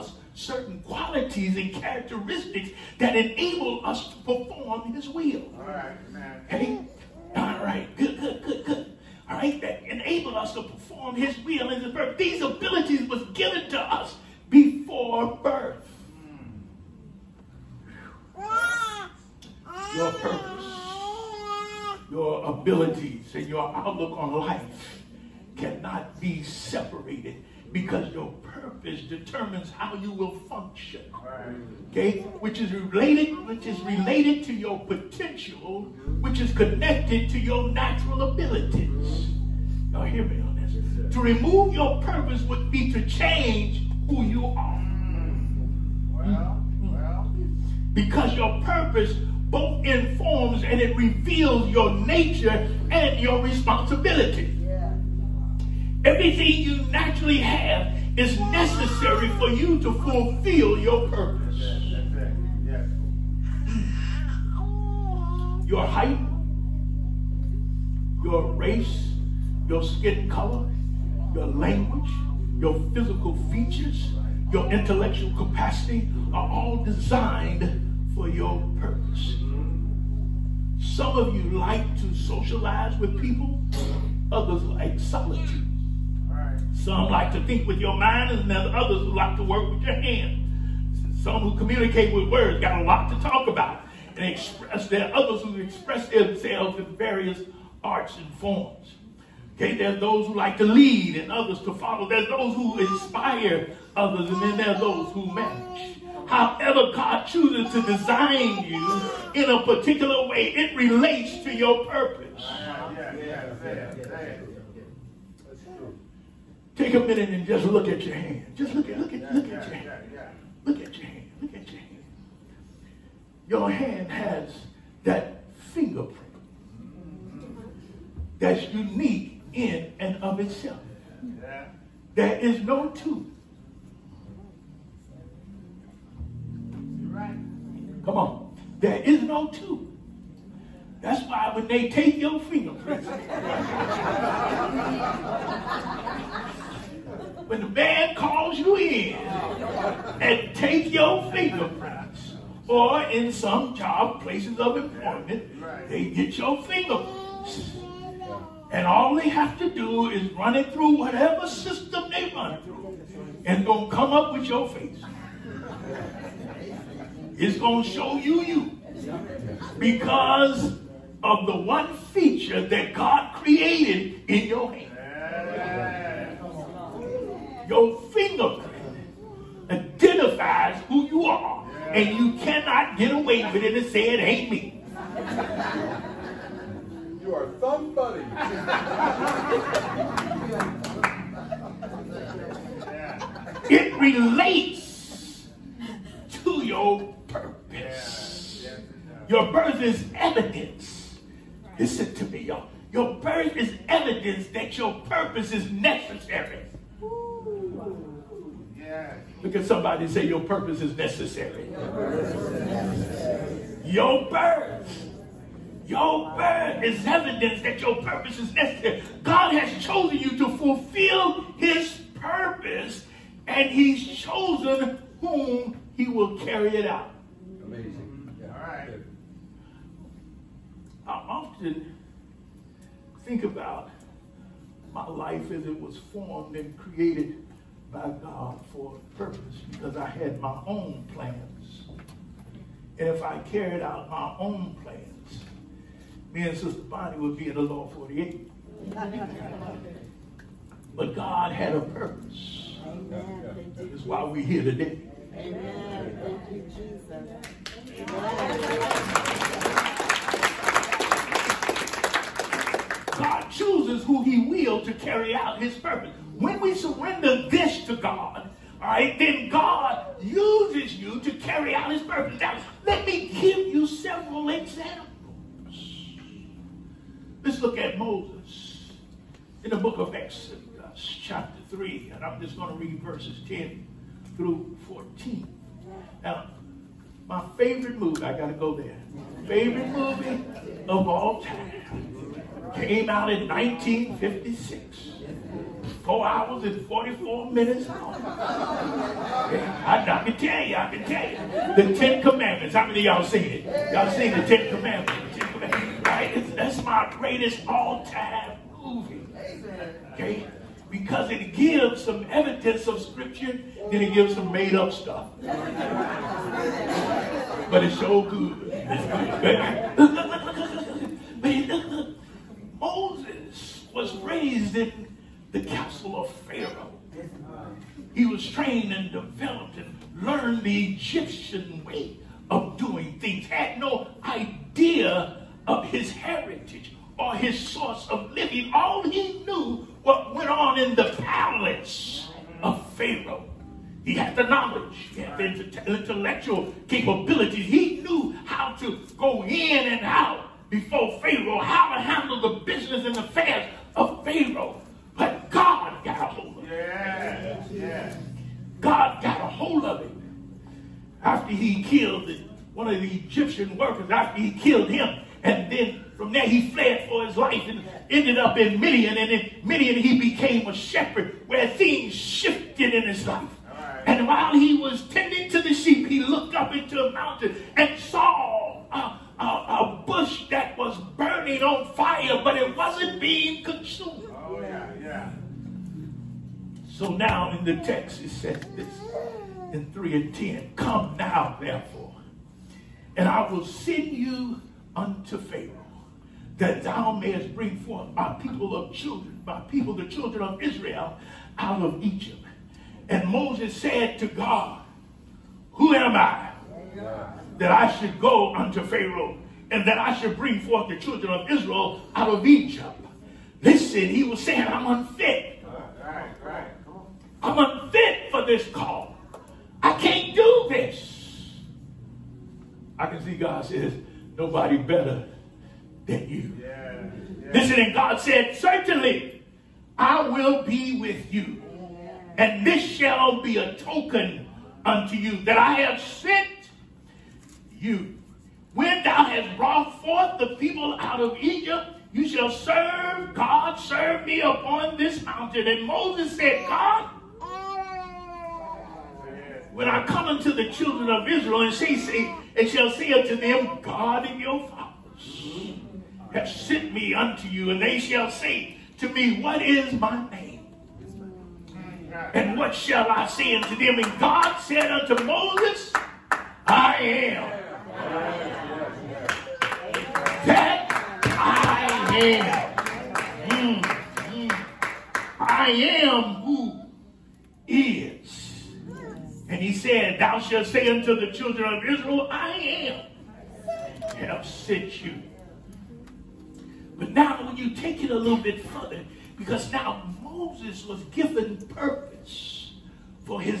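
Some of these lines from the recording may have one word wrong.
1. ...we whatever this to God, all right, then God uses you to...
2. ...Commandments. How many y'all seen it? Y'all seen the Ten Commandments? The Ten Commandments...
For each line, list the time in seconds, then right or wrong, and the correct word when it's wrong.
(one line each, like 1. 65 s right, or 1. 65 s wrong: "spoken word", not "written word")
1. 266 s wrong: "surrender", not "whatever"
2. 302 s right.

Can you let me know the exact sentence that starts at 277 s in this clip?
Let's look at Moses in the book of Exodus, chapter 3, and I'm just going to read verses 10 through 14.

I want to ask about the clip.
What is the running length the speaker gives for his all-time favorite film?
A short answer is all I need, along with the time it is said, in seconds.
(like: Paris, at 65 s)
4 hours 44 minutes, at 296 s.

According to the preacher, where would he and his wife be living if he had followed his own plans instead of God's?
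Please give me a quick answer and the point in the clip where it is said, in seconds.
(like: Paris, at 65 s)
Lower 48, at 247 s.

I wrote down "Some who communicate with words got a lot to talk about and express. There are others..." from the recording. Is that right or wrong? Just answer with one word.
right.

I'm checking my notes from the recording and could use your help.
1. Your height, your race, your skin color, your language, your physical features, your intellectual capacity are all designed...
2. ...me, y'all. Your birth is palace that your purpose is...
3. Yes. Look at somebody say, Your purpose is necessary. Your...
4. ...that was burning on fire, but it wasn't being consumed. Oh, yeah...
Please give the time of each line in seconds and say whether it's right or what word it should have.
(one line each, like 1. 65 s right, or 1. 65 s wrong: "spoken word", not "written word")
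1. 65 s right
2. 202 s wrong: "evidence", not "palace"
3. 208 s right
4. 380 s right.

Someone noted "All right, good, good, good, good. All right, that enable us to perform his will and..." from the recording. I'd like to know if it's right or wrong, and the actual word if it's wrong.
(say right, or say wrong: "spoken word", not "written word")
right.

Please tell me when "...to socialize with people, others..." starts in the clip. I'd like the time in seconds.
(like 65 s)
81 s.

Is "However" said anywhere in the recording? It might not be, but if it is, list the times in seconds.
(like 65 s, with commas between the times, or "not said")
106 s.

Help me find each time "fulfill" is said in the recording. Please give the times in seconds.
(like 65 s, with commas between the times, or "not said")
59 s, 220 s.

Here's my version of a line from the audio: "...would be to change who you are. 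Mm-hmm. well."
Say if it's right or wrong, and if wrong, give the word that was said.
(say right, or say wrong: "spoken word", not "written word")
right.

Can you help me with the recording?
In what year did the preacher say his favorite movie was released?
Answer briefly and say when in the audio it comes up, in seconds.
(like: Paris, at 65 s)
1956, at 293 s.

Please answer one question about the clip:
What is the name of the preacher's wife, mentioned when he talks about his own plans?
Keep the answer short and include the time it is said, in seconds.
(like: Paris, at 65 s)
Sister Bonnie, at 246 s.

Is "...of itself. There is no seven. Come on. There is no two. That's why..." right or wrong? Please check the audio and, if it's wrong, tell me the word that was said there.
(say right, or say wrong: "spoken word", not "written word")
wrong: "two", not "seven".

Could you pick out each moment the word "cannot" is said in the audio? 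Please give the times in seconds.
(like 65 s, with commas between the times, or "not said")
25 s, 182 s.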